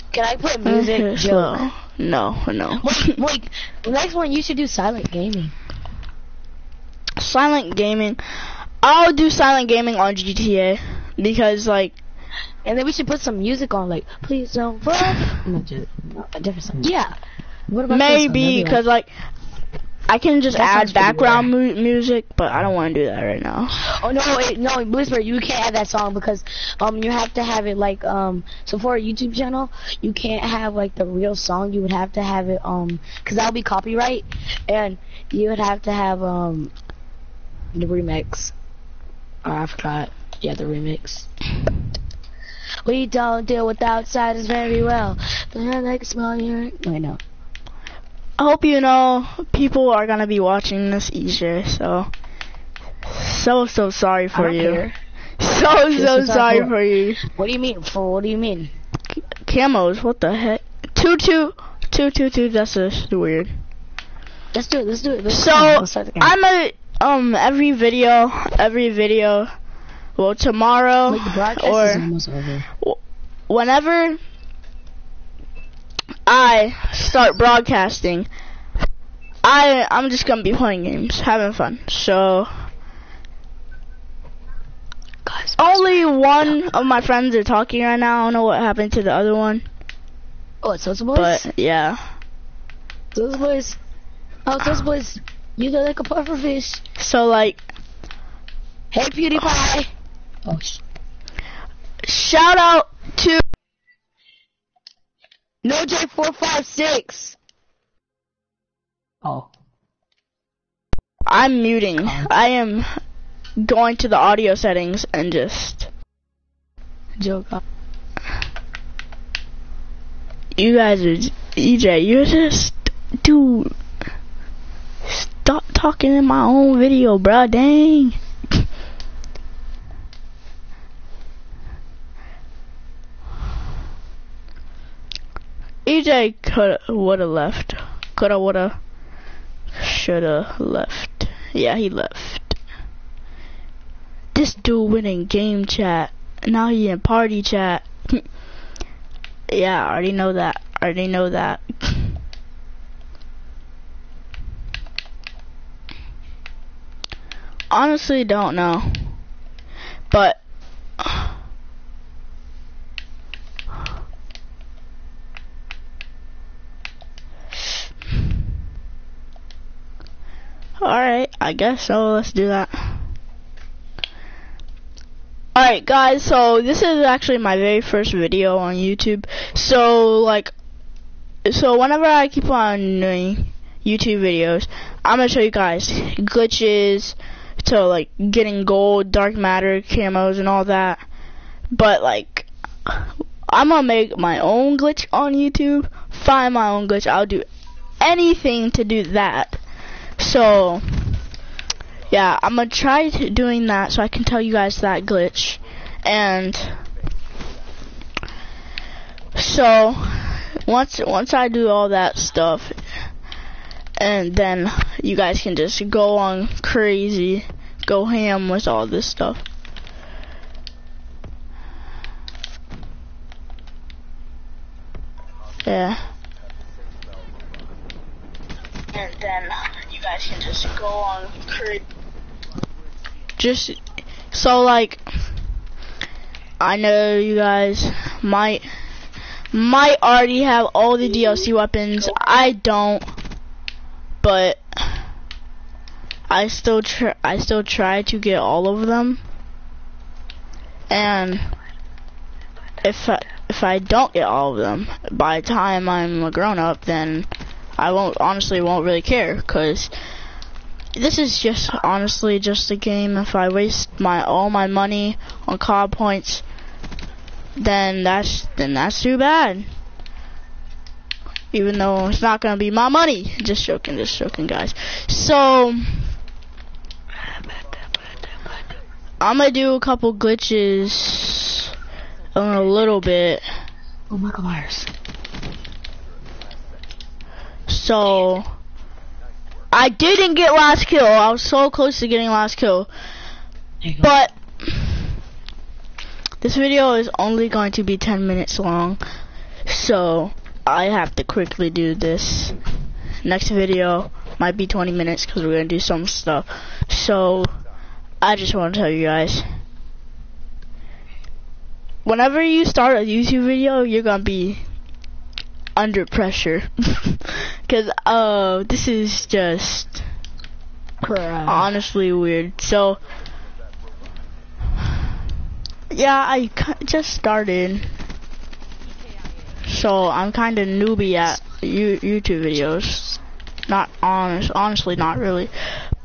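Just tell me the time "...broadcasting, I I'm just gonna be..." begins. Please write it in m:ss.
1:17.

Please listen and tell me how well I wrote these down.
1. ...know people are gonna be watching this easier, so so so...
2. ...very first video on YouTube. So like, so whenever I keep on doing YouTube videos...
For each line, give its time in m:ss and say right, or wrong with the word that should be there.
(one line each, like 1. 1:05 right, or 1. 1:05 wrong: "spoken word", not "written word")
1. 0:48 right
2. 2:57 right.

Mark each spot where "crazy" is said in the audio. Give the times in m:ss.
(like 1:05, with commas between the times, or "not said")
3:36, 3:51.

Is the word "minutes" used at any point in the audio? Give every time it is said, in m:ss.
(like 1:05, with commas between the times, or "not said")
4:58, 5:04.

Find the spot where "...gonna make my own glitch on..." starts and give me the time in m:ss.
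3:13.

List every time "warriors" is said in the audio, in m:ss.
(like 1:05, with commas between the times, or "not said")
not said.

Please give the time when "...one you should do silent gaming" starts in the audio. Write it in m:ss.
0:04.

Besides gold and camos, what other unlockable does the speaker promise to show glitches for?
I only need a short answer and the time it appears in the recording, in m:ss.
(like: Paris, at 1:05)
Dark matter, at 3:09.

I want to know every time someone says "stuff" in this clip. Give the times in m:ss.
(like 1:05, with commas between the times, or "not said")
3:32, 3:39, 5:06.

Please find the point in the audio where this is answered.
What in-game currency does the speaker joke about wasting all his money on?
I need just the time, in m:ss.
4:25.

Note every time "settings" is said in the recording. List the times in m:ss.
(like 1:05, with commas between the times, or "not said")
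1:54.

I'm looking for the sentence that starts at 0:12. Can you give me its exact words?
And then we should put some music on, like please don't fuck.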